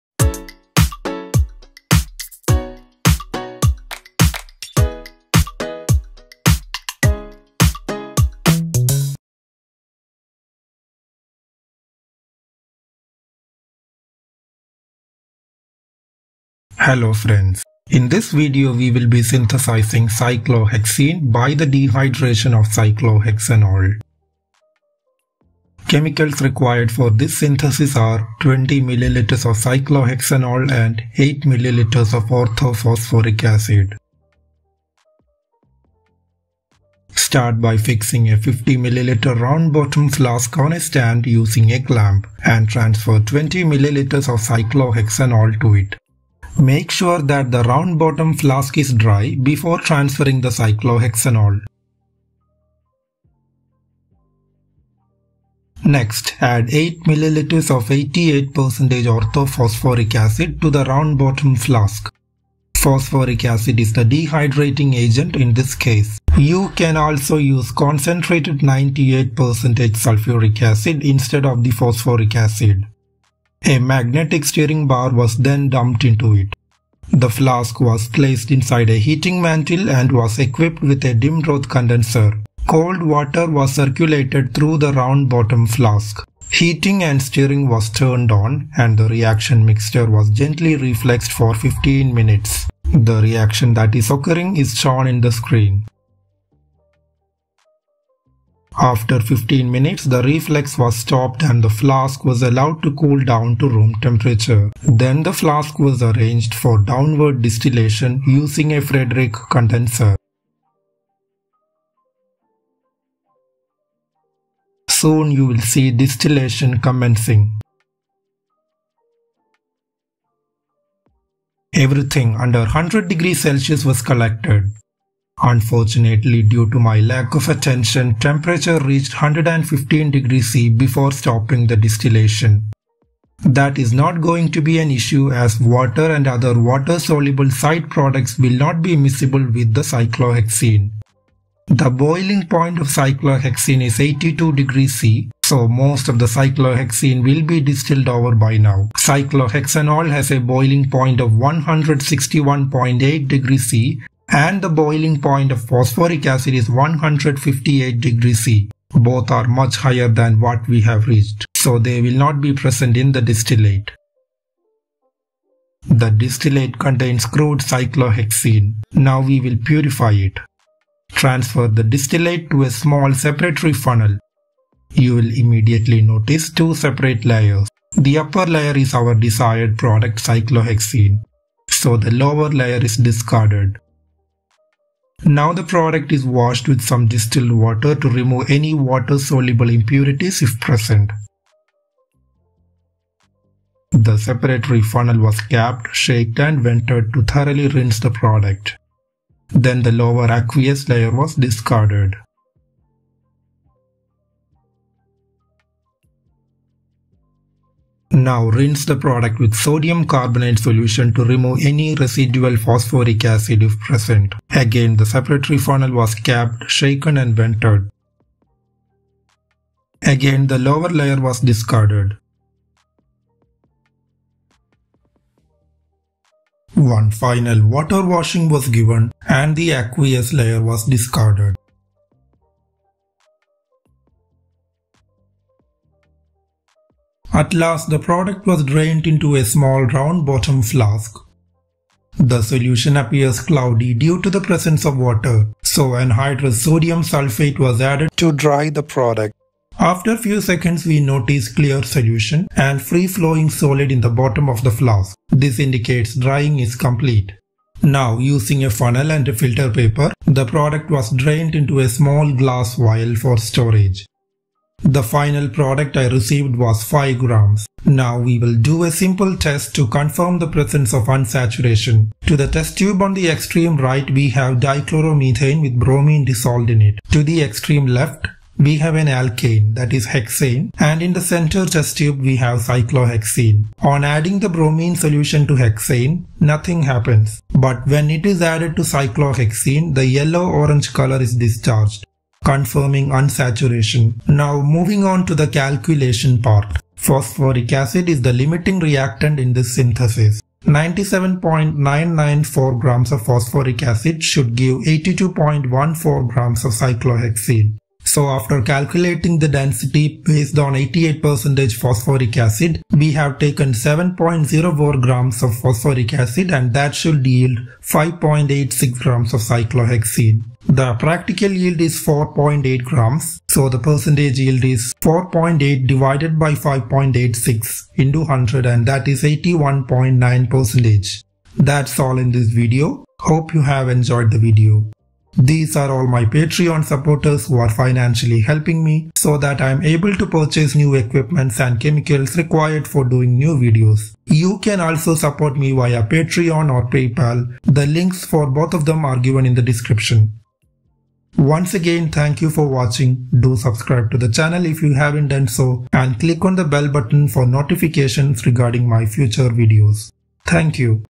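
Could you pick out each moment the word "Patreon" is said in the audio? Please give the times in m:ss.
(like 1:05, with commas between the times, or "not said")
5:36, 5:46.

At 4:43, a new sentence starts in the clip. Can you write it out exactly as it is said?
On adding the bromine solution to hexane, nothing happens.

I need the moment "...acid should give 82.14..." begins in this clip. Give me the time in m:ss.
5:03.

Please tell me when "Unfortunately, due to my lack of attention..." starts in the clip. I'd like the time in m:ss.
2:05.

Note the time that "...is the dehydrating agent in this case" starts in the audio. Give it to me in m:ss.
1:03.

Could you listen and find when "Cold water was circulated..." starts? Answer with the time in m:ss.
1:22.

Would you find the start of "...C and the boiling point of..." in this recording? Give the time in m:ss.
2:33.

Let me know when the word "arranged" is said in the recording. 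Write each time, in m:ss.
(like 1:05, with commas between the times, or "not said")
1:46.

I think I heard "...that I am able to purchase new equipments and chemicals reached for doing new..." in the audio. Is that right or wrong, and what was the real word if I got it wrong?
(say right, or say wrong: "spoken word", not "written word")
wrong: "required", not "reached".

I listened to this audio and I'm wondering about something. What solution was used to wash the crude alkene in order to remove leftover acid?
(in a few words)
sodium carbonate.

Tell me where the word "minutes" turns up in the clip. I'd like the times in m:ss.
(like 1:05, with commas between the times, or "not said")
1:32, 1:39.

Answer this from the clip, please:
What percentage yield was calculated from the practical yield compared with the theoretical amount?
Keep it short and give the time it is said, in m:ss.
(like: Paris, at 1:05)
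81.9%, at 5:29.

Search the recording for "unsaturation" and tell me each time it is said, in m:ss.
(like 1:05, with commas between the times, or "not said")
4:31, 4:53.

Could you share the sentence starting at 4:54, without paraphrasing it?
Now moving on to the calculation part.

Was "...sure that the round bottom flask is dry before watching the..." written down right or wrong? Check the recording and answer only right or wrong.
wrong.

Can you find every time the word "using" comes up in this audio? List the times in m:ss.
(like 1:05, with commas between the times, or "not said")
0:41, 1:48, 4:18.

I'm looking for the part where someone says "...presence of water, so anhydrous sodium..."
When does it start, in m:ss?
4:04.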